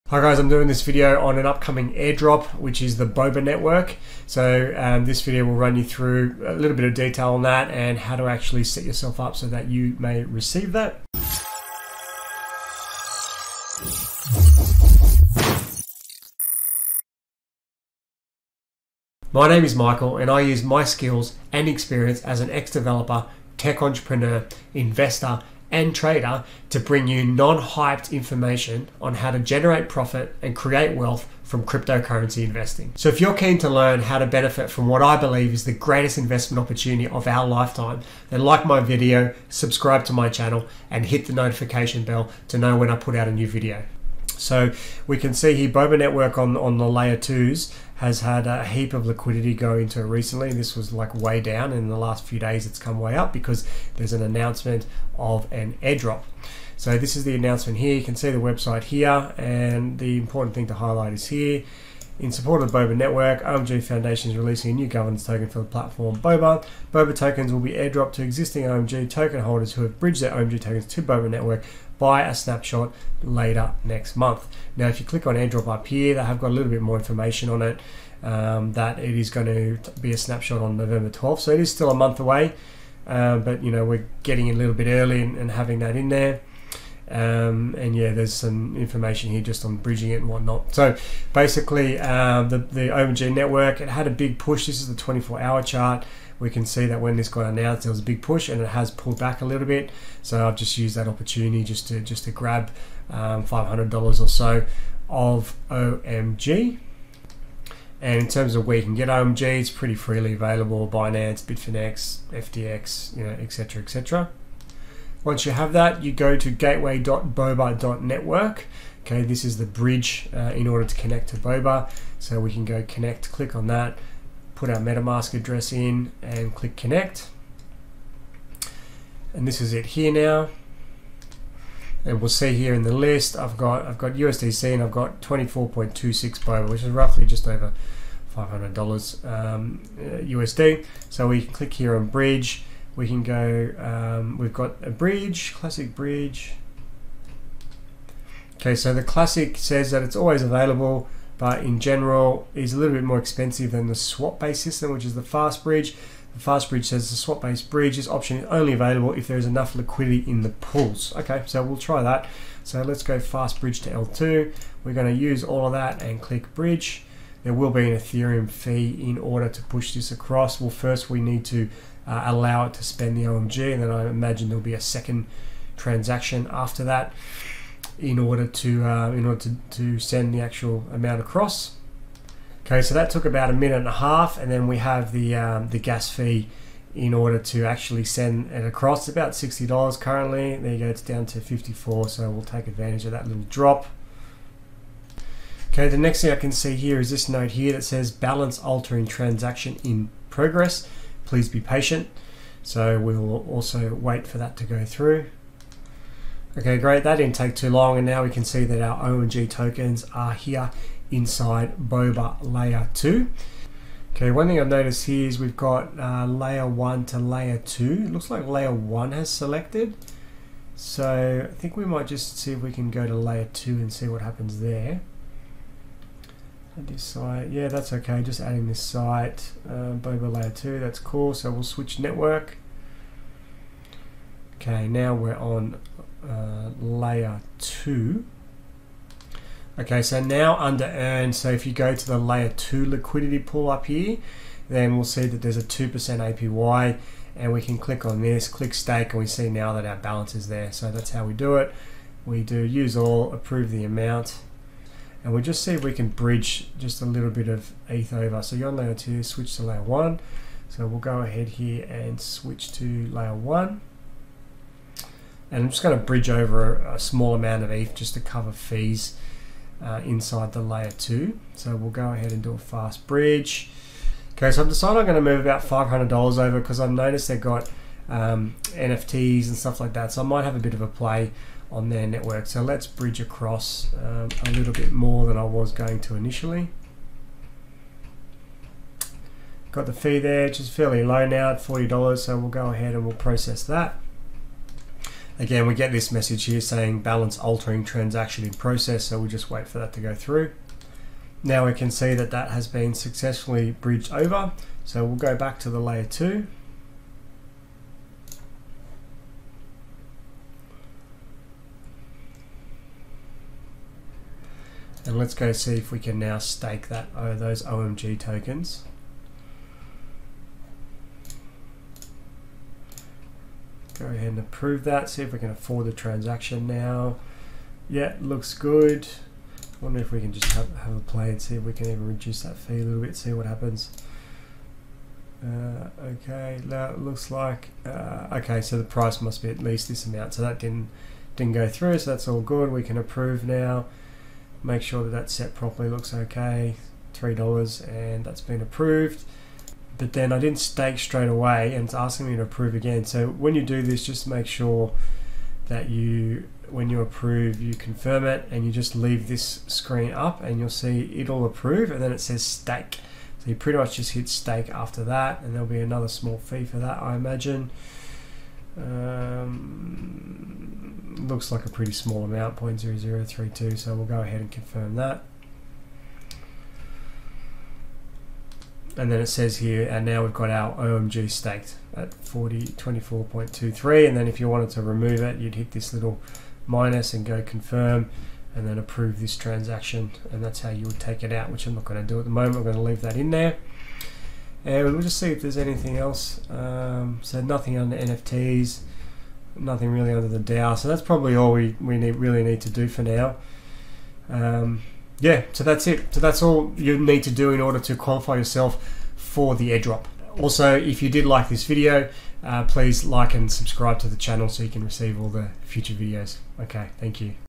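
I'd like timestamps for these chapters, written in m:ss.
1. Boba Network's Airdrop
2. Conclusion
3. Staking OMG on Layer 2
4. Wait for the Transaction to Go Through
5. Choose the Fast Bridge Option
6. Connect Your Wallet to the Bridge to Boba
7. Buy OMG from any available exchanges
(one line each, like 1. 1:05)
1. 0:45
2. 6:45
3. 3:35
4. 3:15
5. 2:32
6. 1:55
7. 1:30.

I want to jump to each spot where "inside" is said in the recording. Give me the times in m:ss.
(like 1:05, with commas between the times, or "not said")
3:31, 4:30.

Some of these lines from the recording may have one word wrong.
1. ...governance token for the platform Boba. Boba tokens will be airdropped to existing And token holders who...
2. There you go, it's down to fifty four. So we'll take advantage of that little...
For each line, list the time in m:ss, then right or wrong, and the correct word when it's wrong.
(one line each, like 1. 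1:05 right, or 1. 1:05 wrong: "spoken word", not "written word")
1. 1:04 wrong: "OMG", not "And"
2. 3:10 right.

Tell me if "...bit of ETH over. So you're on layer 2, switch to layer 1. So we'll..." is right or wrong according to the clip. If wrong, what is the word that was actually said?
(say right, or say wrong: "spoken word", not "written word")
right.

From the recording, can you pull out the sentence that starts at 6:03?
So you pretty much just hit stake after that and there'll be another small fee for that, I imagine.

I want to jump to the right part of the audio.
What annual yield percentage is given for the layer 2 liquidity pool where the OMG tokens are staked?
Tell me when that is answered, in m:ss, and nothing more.
4:05.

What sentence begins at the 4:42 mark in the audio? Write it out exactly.
So let's bridge across um, a little bit more than I was going to initially.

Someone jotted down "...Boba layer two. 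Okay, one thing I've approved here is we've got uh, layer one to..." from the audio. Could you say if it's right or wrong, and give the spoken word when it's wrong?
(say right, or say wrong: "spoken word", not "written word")
wrong: "noticed", not "approved".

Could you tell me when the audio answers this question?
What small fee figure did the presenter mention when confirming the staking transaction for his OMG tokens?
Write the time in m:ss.
6:12.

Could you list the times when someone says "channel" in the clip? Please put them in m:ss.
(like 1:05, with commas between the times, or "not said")
0:40, 6:54.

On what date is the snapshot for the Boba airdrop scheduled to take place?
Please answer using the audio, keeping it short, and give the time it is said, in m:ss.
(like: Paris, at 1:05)
November 12th, at 1:20.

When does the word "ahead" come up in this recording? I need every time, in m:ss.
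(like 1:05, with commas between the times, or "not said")
4:21, 4:32, 4:52, 5:24, 6:14.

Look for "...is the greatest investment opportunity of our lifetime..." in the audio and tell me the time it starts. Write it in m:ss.
0:35.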